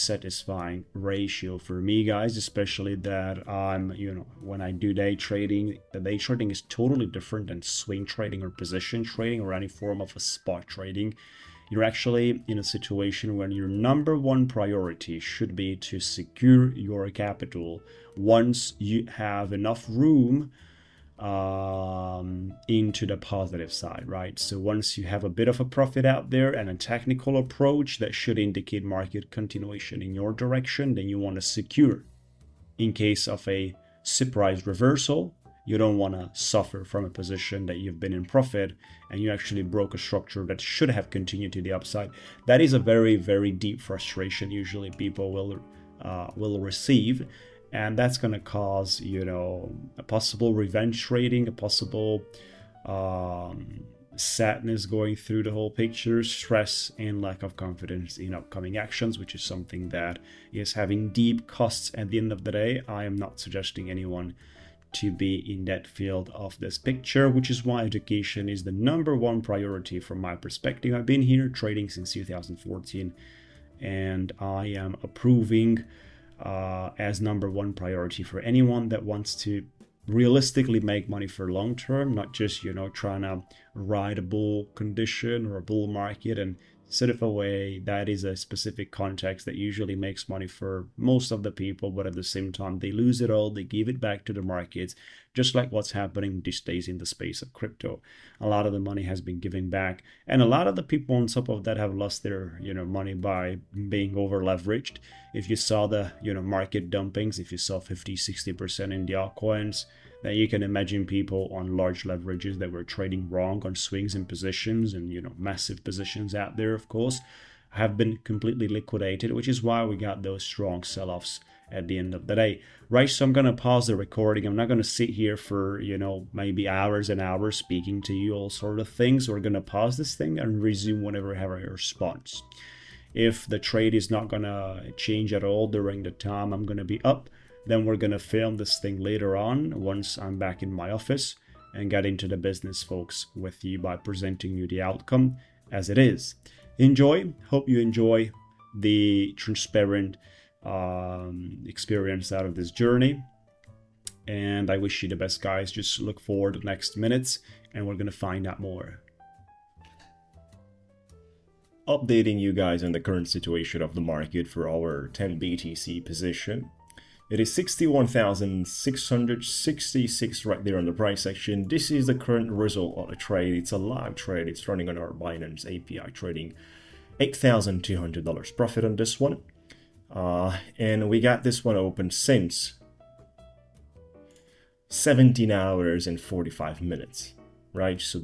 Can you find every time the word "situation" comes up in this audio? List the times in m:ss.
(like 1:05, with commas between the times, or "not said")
0:12, 2:43.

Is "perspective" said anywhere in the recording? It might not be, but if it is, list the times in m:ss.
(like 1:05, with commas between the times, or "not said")
1:10.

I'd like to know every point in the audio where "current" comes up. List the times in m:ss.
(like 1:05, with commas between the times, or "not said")
2:42, 2:52.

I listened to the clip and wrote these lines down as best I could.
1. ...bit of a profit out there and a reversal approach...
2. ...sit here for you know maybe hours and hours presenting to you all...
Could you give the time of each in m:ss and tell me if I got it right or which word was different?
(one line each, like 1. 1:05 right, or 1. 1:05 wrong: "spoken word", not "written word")
1. 0:25 wrong: "technical", not "reversal"
2. 2:04 wrong: "speaking", not "presenting".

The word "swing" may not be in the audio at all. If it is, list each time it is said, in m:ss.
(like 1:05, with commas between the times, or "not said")
0:07, 1:53.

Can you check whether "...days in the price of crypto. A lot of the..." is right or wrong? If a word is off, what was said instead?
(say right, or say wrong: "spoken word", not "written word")
wrong: "space", not "price".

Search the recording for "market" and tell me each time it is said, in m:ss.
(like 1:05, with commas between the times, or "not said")
0:28, 1:25, 1:34, 1:46, 2:43.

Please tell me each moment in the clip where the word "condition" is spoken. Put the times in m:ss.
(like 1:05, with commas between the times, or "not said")
1:24.